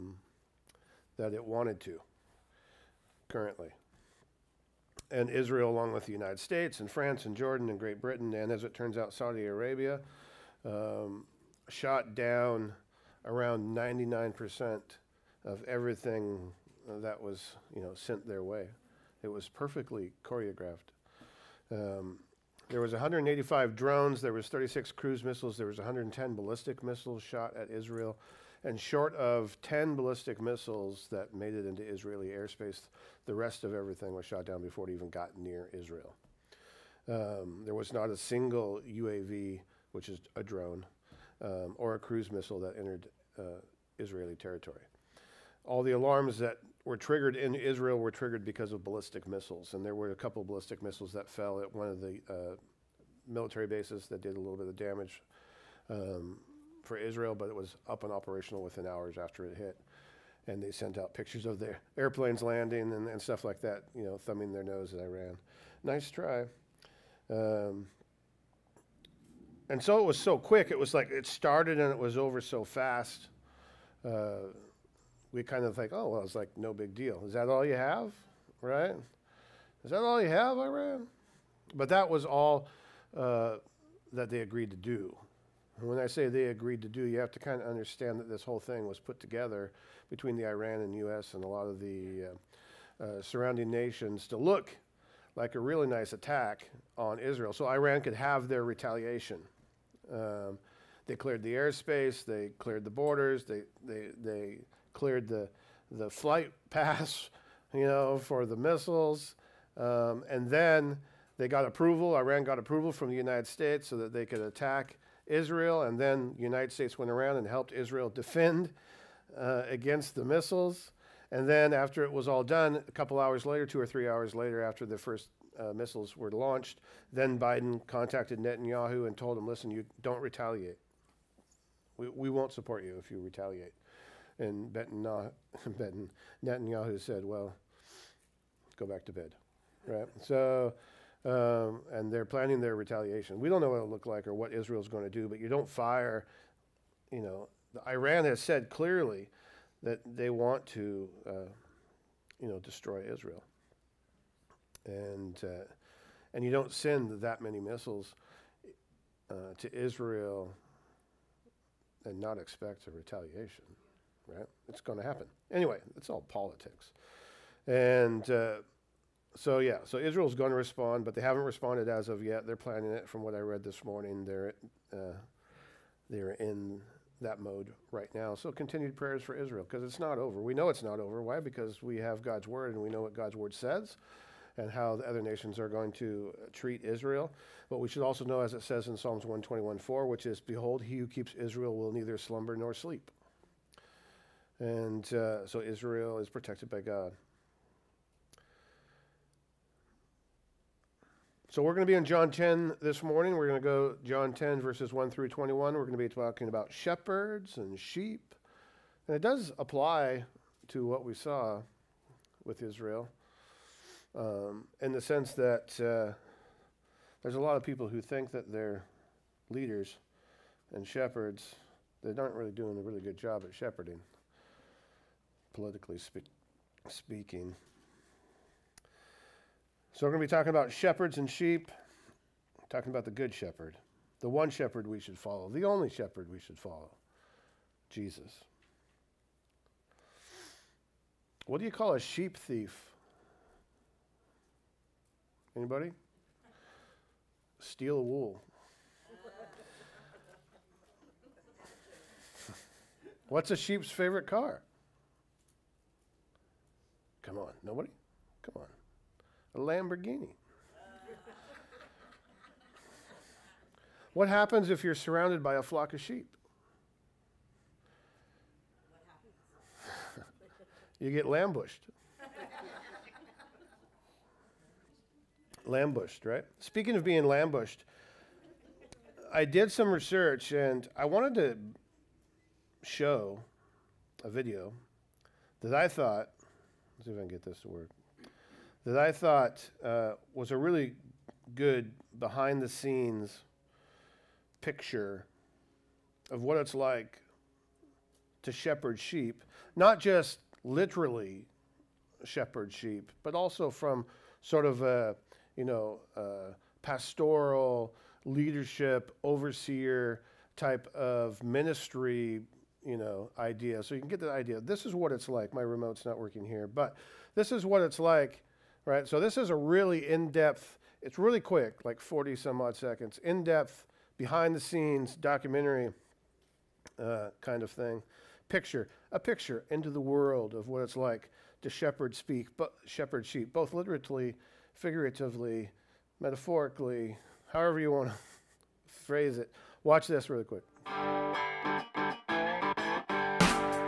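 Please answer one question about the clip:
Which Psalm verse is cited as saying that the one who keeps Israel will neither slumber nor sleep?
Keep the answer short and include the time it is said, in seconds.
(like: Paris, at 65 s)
Psalms 121:4, at 188 s.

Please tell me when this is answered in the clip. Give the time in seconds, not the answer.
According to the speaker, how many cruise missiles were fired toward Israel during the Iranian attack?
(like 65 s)
24 s.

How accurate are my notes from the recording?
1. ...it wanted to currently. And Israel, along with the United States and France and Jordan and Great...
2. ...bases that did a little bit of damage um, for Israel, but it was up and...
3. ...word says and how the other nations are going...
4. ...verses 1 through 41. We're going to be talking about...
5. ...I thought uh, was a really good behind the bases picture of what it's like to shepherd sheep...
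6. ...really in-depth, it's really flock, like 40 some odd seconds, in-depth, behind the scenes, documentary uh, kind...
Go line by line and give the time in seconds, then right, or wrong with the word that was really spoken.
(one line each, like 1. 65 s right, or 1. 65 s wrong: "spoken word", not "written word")
1. 1 s right
2. 53 s right
3. 183 s right
4. 204 s wrong: "21", not "41"
5. 288 s wrong: "scenes", not "bases"
6. 319 s wrong: "quick", not "flock".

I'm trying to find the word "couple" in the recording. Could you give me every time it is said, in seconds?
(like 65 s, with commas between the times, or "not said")
50 s, 122 s.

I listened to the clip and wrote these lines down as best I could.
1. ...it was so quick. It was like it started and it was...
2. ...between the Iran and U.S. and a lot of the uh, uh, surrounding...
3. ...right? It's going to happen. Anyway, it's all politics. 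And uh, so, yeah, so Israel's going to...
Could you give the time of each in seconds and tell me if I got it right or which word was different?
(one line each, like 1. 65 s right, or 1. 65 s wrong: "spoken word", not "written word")
1. 69 s right
2. 90 s right
3. 164 s right.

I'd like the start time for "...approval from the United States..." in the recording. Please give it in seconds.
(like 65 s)
112 s.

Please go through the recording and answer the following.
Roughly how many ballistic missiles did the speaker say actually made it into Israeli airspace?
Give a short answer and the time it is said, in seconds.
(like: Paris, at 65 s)
10, at 29 s.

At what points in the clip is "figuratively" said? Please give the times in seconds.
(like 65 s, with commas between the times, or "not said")
334 s.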